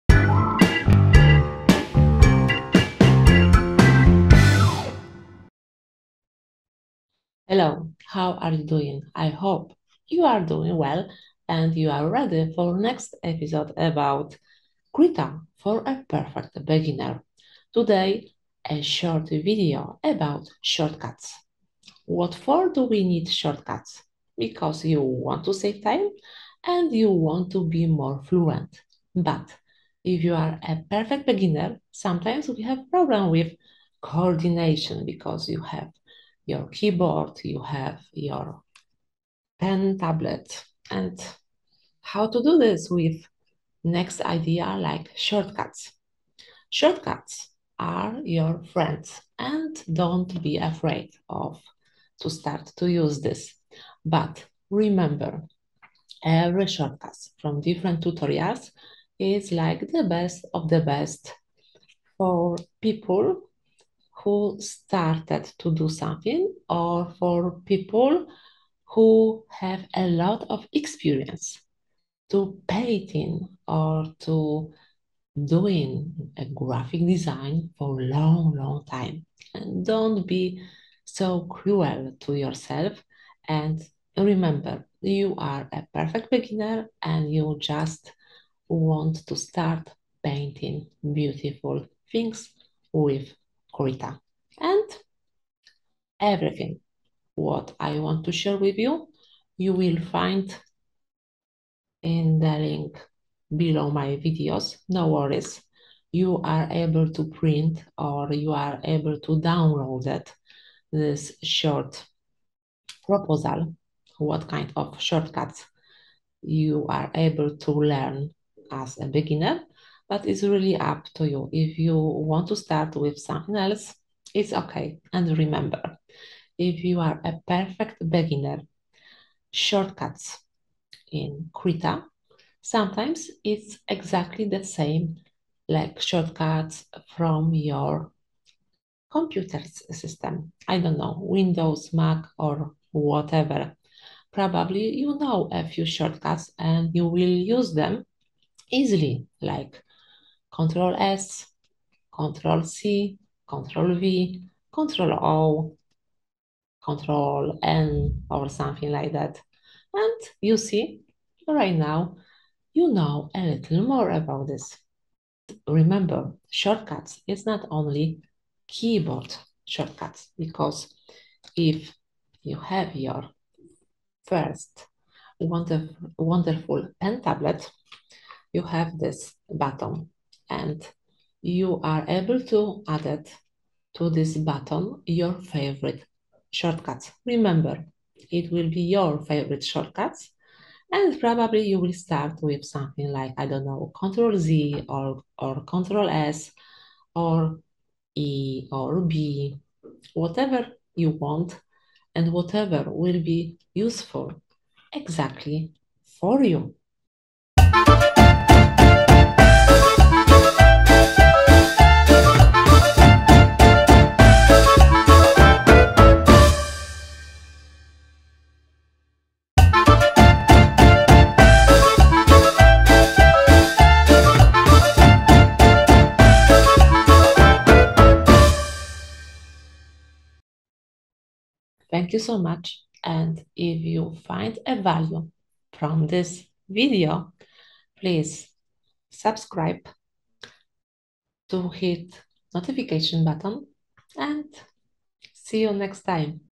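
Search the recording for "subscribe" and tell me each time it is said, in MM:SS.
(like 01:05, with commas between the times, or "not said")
03:59.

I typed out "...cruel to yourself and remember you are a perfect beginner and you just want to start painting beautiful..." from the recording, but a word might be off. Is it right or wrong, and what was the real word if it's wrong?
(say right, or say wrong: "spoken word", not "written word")
right.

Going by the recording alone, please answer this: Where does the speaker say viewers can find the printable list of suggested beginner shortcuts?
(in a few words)
In the link below.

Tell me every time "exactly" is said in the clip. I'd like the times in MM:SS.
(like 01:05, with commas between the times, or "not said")
02:13, 03:24.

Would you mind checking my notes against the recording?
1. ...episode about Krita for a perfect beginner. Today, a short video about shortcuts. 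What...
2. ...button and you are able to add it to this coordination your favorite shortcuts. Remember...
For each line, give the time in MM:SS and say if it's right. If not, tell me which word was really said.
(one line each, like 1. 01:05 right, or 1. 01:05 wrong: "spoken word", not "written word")
1. 00:13 right
2. 02:59 wrong: "button", not "coordination".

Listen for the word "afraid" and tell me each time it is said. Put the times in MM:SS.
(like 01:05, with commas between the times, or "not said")
00:50.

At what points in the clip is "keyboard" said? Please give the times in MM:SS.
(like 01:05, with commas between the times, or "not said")
00:36, 02:48.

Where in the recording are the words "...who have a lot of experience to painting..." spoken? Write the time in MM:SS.
01:08.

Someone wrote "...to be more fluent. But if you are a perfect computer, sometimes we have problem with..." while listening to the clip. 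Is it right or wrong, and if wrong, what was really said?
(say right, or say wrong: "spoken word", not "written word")
wrong: "beginner", not "computer".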